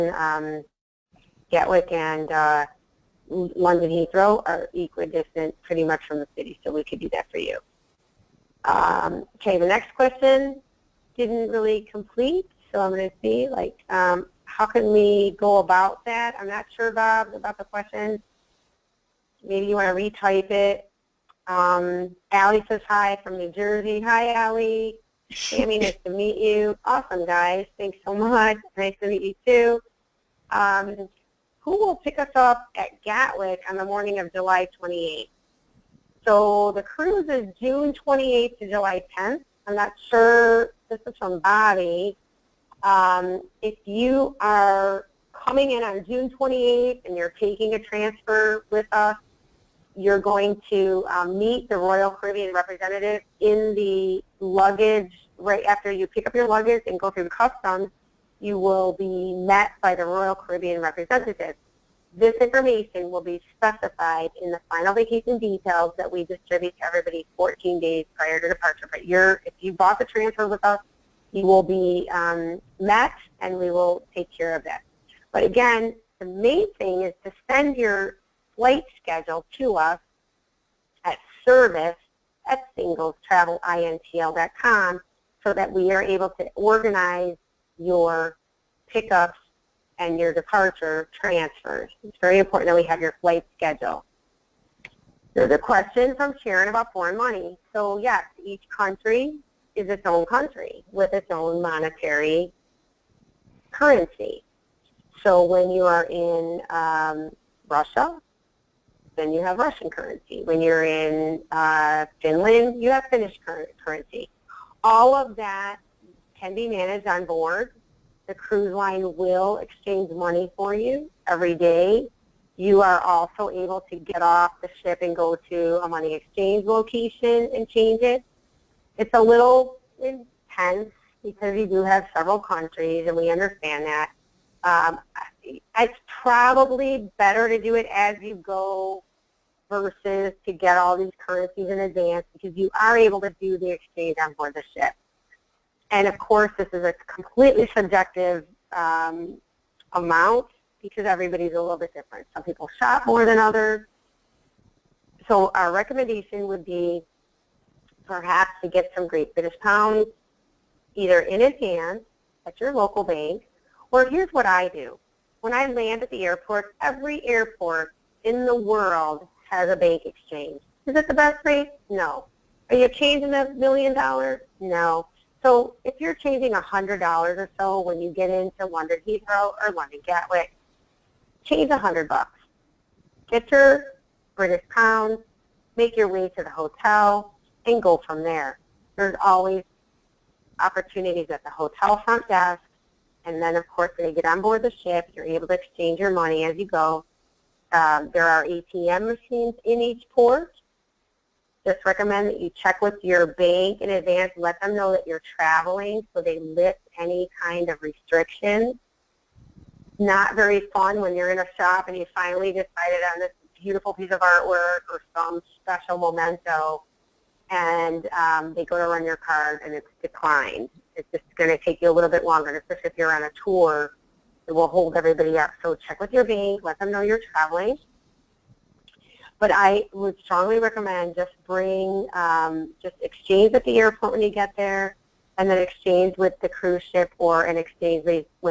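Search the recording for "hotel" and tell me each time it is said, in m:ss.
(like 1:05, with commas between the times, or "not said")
3:06, 3:11.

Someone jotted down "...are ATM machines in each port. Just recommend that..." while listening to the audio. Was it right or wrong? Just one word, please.
right.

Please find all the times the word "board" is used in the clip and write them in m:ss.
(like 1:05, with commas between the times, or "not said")
1:57, 2:24, 3:14.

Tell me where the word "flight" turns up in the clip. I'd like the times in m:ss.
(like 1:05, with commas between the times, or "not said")
1:18, 1:33.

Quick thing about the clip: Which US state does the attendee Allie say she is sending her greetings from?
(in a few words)
New Jersey.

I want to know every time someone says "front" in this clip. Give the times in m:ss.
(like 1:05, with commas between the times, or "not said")
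3:12.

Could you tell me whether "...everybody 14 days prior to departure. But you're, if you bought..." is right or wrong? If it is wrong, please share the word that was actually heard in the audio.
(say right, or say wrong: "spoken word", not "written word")
right.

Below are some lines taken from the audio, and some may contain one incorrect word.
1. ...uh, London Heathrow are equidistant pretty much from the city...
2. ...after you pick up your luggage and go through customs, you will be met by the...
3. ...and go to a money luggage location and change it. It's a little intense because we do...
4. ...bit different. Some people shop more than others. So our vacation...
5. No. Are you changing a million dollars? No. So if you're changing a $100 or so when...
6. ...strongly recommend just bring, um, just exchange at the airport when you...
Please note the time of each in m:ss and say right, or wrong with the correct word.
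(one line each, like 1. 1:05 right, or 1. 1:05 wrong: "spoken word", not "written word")
1. 0:02 right
2. 0:55 right
3. 2:05 wrong: "exchange", not "luggage"
4. 2:31 wrong: "recommendation", not "vacation"
5. 2:51 right
6. 3:50 right.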